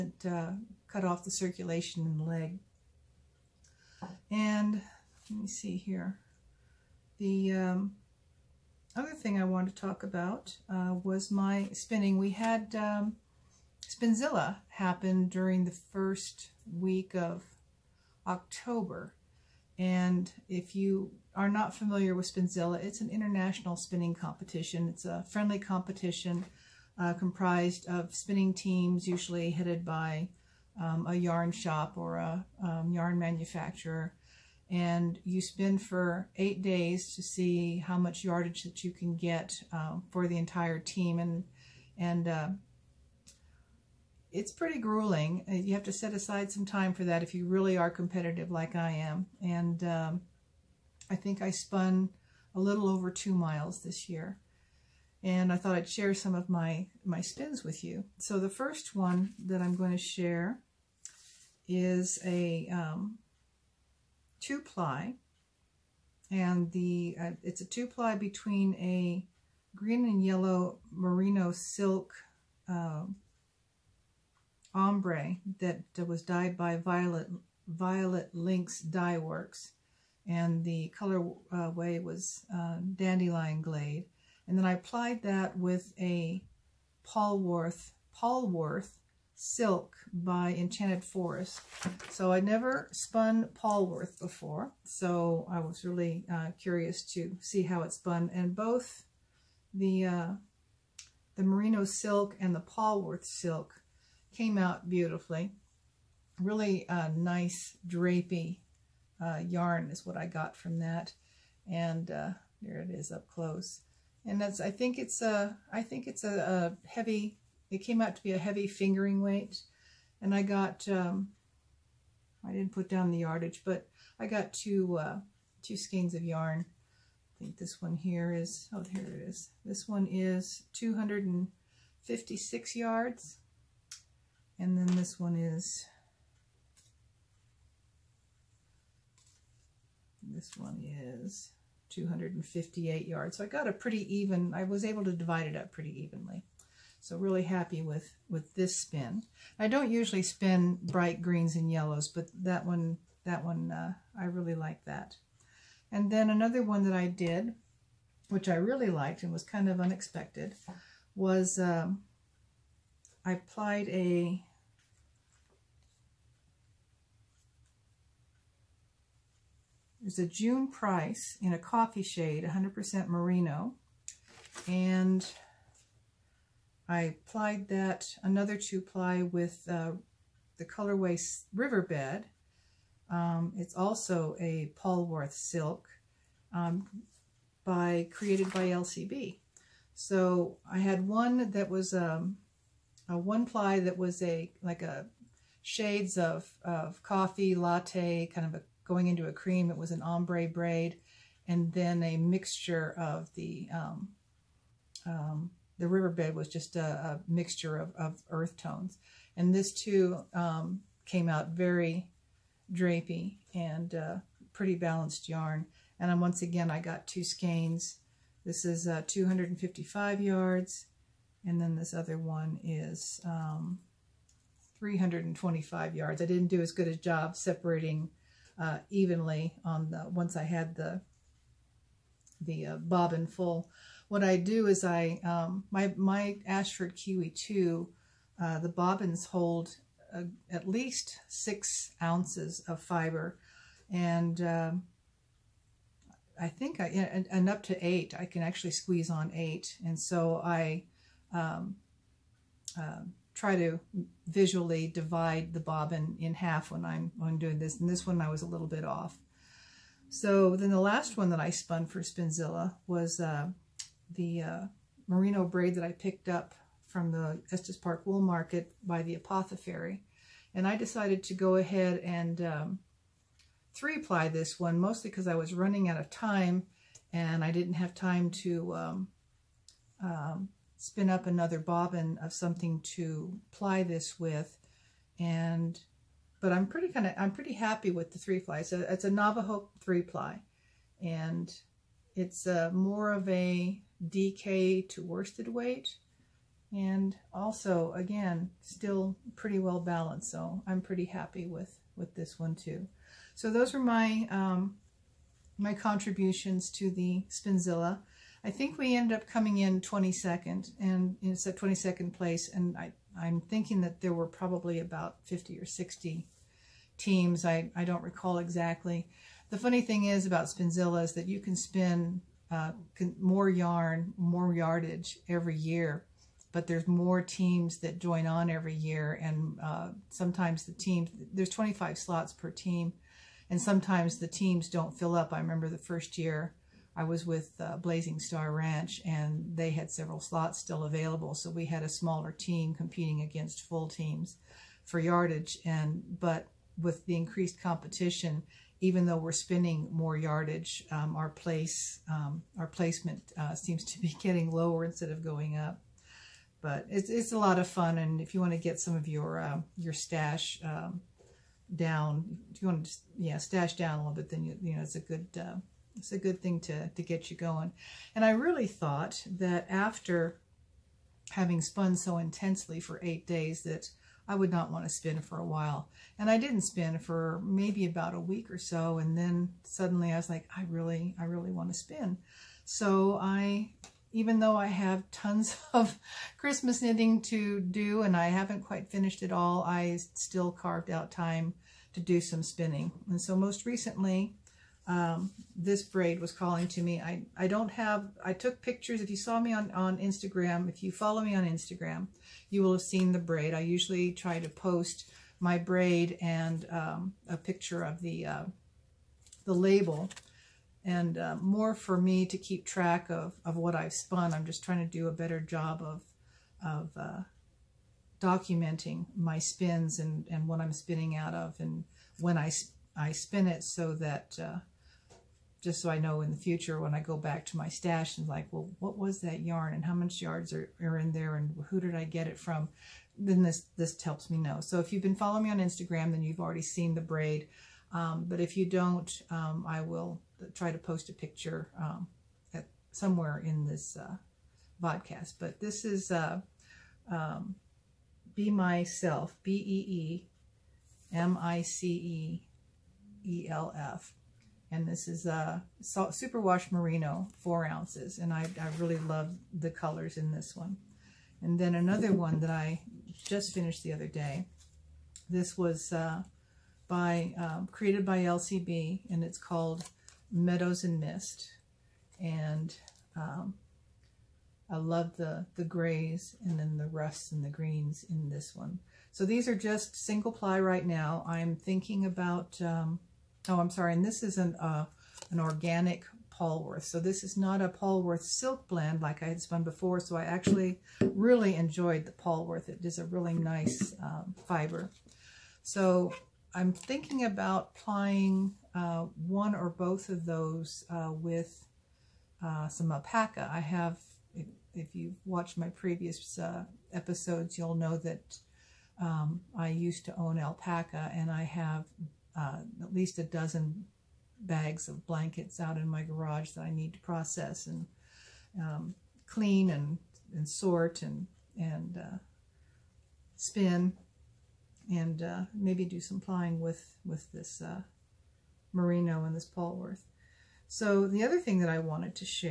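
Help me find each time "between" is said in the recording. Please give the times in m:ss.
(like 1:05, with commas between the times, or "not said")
1:08.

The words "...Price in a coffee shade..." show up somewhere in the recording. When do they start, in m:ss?
2:50.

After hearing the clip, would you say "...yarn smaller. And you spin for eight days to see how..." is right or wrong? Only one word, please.
wrong.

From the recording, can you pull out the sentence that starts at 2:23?
So I got a pretty even, I was able to divide it up pretty evenly.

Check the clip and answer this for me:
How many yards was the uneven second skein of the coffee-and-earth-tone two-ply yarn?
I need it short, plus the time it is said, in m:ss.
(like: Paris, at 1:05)
325 yards, at 3:44.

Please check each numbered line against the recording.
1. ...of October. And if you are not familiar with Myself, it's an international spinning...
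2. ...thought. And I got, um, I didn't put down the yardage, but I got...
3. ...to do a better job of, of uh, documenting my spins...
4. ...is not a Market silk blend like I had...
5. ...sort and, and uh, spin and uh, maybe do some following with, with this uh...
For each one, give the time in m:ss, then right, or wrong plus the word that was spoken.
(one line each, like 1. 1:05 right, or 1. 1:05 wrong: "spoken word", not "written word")
1. 0:17 wrong: "Spinzilla", not "Myself"
2. 1:59 wrong: "weight", not "thought"
3. 6:54 right
4. 8:07 wrong: "Polworth", not "Market"
5. 8:40 wrong: "plying", not "following".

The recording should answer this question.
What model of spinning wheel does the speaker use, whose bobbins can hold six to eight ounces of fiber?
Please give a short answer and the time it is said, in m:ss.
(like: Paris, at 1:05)
Ashford Kiwi 2, at 3:56.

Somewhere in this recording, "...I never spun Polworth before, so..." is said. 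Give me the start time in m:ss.
1:32.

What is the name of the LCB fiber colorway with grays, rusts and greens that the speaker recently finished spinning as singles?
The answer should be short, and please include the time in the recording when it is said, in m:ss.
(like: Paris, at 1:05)
Meadows and Mist, at 7:50.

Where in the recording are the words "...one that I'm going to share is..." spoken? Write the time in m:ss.
0:58.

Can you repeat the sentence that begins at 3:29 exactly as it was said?
And this too um, came out very drapey and uh, pretty balanced yarn.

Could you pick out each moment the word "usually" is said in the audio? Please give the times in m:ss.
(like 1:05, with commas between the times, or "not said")
0:29, 2:29, 6:43.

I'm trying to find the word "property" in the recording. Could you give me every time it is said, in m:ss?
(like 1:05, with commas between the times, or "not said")
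not said.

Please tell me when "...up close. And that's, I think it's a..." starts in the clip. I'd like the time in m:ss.
1:53.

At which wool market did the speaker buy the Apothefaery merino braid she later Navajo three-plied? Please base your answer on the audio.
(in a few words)
Estes Park Wool Market.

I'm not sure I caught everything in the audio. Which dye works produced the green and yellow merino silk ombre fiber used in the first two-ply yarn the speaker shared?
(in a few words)
Violet Lynx Dye Works.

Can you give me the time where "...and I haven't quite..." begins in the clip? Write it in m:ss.
6:28.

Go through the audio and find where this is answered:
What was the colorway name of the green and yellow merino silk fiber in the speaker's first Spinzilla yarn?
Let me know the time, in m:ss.
1:22.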